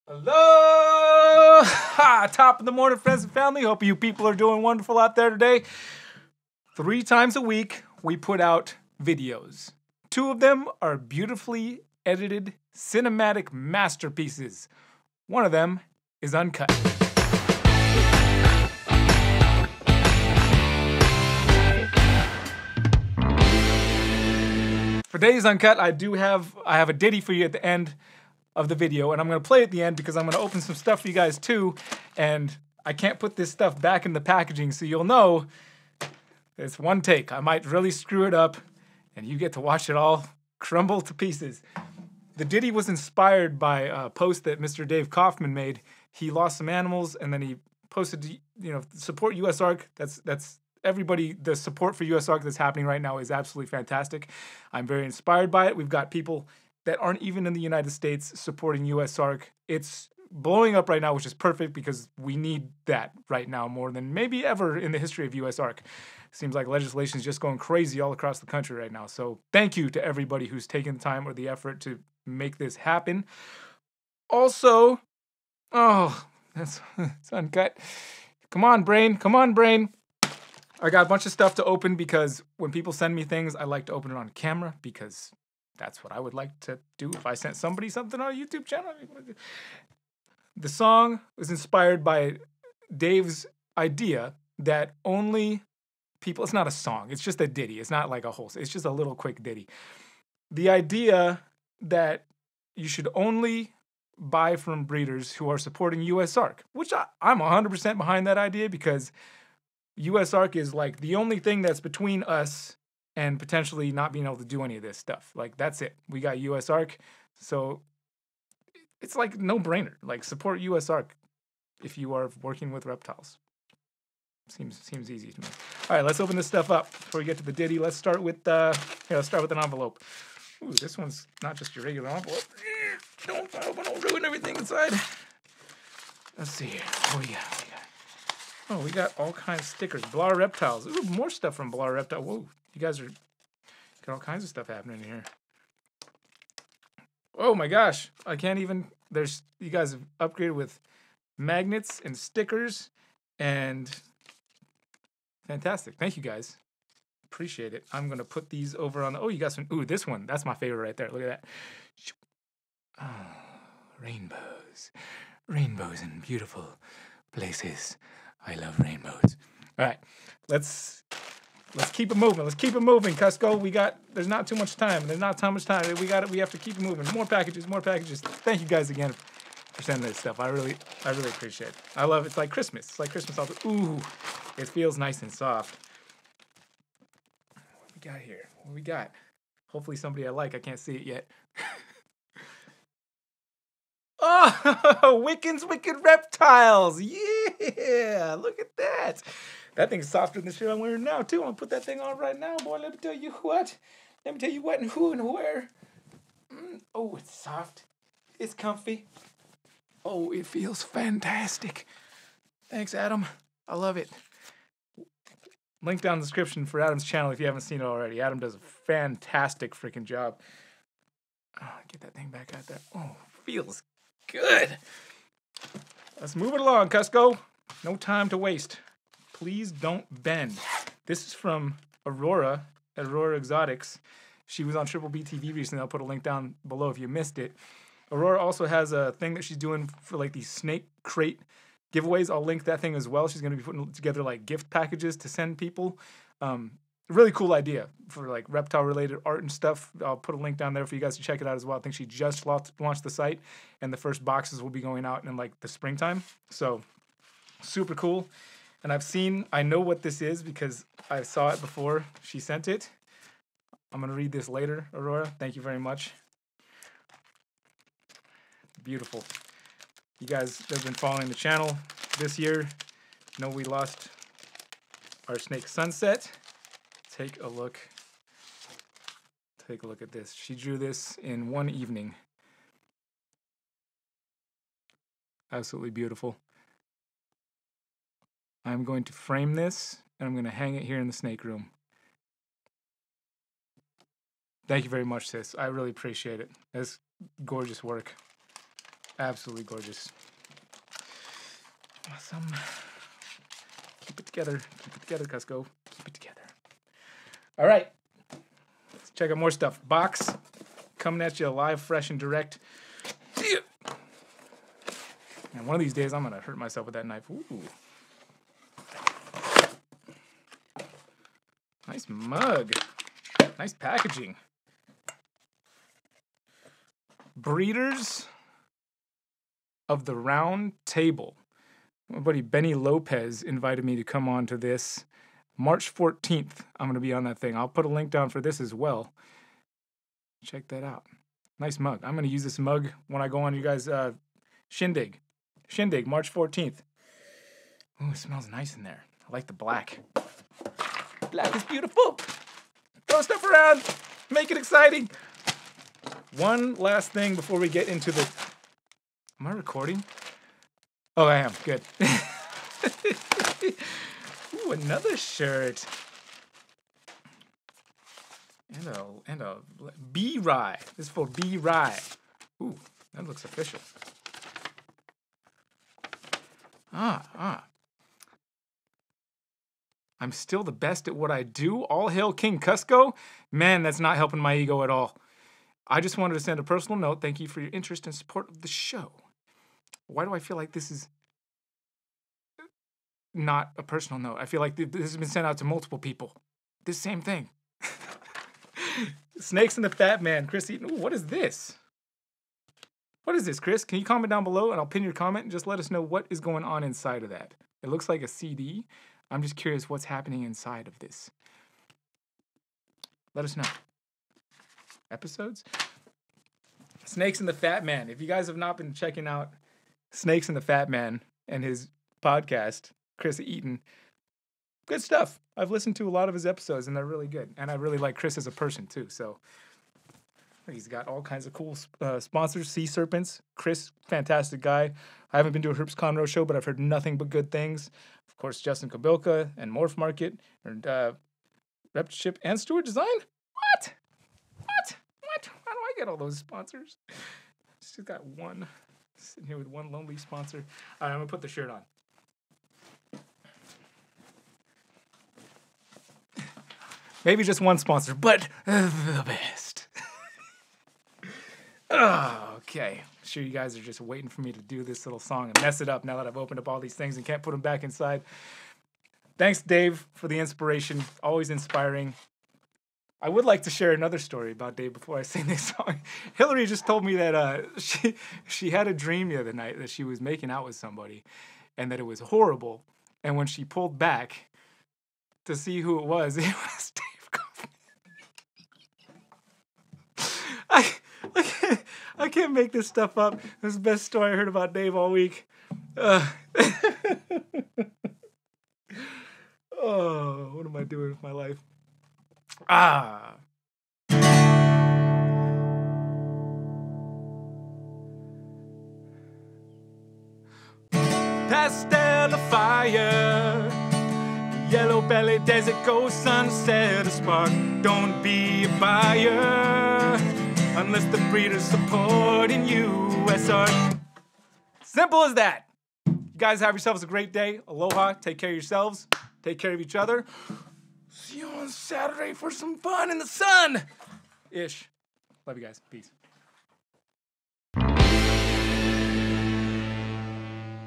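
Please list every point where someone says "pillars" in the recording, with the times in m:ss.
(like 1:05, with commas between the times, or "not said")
not said.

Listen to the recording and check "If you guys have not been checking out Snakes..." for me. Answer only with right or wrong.
right.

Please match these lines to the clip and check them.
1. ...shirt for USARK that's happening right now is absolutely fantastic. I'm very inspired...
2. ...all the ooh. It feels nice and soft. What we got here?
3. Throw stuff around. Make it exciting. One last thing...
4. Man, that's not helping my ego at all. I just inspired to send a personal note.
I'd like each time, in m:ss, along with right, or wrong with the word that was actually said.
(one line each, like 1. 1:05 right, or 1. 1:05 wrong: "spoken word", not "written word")
1. 0:51 wrong: "support", not "shirt"
2. 3:03 right
3. 5:53 right
4. 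6:23 wrong: "wanted", not "inspired".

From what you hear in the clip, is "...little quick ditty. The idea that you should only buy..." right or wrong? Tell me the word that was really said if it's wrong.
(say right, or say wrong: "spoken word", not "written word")
right.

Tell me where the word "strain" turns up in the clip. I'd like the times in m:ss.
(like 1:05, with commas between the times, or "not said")
not said.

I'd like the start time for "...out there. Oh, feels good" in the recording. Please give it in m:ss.
3:42.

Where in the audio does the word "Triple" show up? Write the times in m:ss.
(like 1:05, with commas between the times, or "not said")
3:54.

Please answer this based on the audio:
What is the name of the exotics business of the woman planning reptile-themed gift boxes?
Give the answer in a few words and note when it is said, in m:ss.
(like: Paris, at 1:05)
Aurora Exotics, at 3:52.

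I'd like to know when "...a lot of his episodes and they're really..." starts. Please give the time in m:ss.
7:06.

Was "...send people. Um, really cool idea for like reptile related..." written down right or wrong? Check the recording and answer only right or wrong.
right.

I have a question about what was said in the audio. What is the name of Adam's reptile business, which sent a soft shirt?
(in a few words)
Wickens Wicked Reptiles.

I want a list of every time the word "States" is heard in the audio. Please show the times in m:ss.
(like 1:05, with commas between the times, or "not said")
0:57.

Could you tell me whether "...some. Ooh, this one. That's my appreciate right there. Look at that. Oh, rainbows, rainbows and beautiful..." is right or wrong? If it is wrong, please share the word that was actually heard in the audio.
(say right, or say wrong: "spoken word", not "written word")
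wrong: "favorite", not "appreciate".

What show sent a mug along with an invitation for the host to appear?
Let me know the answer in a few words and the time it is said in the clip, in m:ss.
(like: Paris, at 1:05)
Breeders of the Round Table, at 5:27.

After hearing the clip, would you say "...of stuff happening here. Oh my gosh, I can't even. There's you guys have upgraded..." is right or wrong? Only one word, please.
right.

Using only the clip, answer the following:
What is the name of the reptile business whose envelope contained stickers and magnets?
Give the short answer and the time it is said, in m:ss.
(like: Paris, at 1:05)
Blar Reptiles, at 2:20.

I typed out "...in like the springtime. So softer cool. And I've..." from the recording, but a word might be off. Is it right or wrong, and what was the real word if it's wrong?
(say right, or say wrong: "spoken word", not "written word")
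wrong: "super", not "softer".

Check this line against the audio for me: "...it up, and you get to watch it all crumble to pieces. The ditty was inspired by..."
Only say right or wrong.
right.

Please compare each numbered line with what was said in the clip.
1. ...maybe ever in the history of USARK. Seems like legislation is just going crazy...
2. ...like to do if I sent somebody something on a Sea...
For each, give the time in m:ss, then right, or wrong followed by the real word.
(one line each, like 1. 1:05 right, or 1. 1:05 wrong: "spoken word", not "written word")
1. 1:04 right
2. 1:26 wrong: "YouTube", not "Sea".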